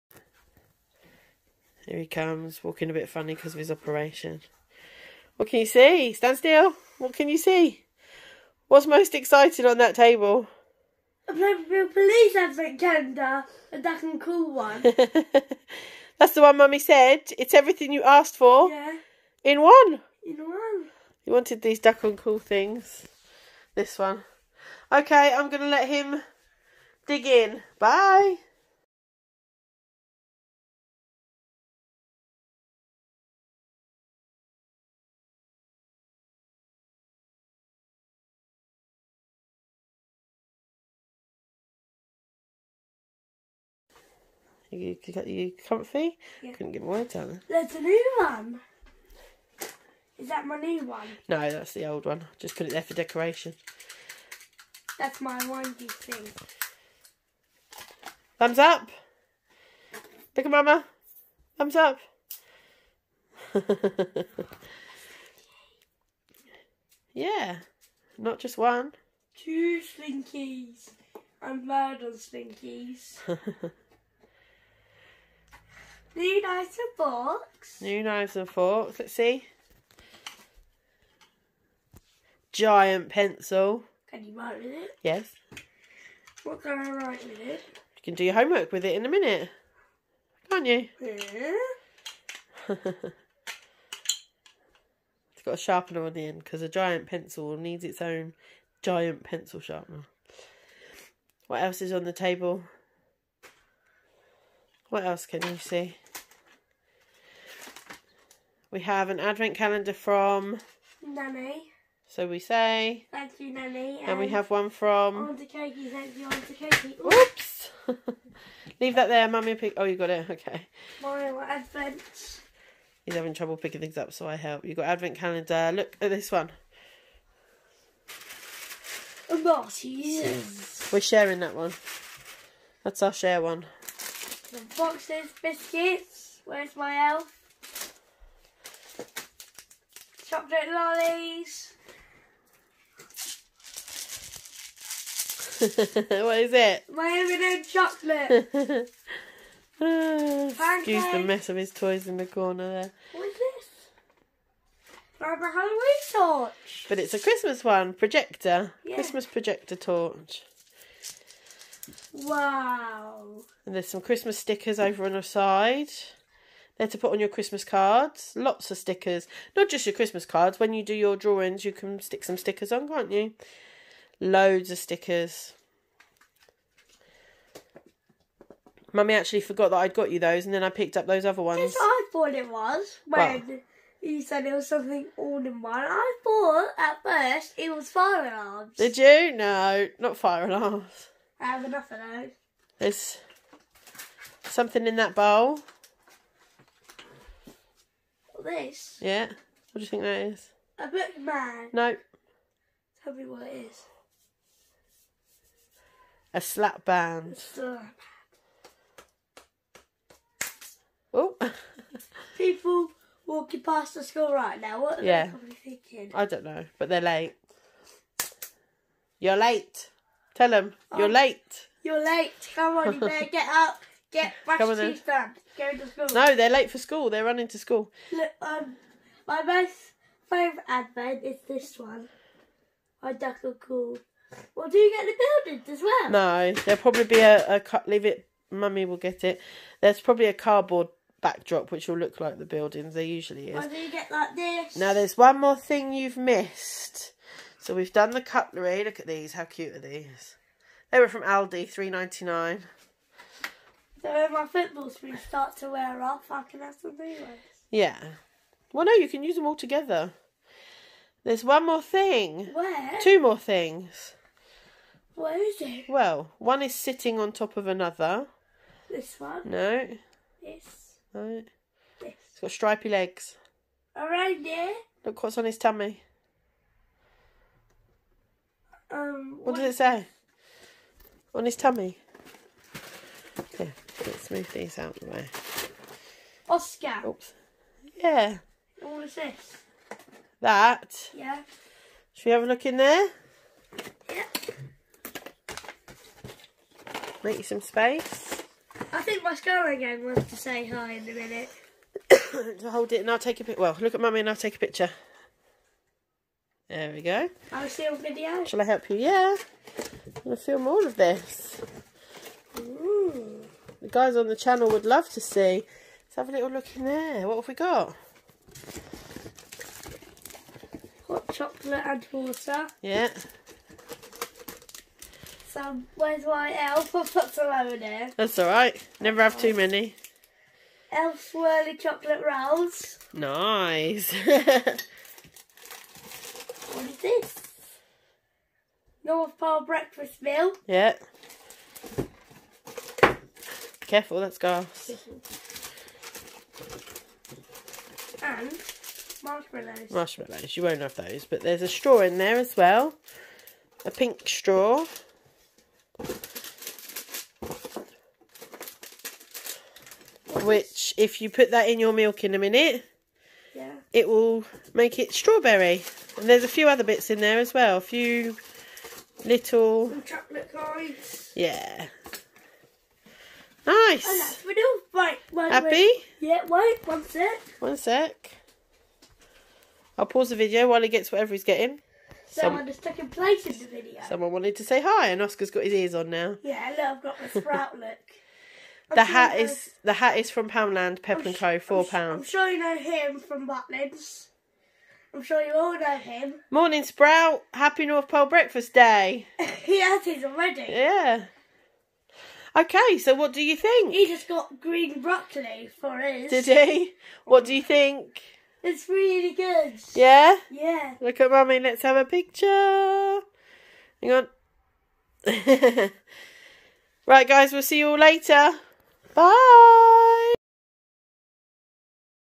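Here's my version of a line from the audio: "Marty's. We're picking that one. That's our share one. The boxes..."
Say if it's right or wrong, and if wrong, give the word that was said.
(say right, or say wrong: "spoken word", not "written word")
wrong: "sharing", not "picking".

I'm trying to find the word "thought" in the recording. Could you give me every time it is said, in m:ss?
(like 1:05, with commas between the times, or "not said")
3:02, 3:06.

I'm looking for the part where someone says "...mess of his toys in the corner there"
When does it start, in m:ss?
2:31.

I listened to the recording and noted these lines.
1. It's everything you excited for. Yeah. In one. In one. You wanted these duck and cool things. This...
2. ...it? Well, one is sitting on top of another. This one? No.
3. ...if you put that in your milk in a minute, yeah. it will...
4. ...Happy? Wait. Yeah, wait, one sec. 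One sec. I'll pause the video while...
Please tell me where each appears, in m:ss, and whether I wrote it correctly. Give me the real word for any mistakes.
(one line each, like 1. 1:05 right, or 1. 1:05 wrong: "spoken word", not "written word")
1. 0:17 wrong: "asked", not "excited"
2. 4:25 right
3. 6:00 right
4. 6:15 right.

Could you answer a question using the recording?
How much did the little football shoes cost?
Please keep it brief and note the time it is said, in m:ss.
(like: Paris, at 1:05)
£3.99, at 4:11.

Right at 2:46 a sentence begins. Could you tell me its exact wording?
They're to put on your Christmas cards.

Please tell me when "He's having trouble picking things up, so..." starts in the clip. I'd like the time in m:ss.
2:03.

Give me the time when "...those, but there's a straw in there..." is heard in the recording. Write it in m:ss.
5:50.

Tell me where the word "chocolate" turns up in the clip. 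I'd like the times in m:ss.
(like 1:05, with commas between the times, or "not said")
2:20, 2:27, 5:21, 5:31, 6:10.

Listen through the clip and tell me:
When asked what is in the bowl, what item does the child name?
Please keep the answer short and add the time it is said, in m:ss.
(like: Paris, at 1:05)
Slap band, at 3:26.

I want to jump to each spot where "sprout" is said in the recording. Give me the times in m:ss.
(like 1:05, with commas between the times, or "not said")
6:27, 6:36.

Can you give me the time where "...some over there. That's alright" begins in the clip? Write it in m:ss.
5:27.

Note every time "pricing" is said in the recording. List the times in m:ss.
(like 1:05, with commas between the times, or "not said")
not said.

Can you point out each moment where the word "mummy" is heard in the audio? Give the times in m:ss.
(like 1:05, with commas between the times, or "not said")
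0:16, 1:59, 2:58, 3:58, 5:04, 6:51.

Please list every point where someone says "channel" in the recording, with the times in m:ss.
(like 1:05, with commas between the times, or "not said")
5:14.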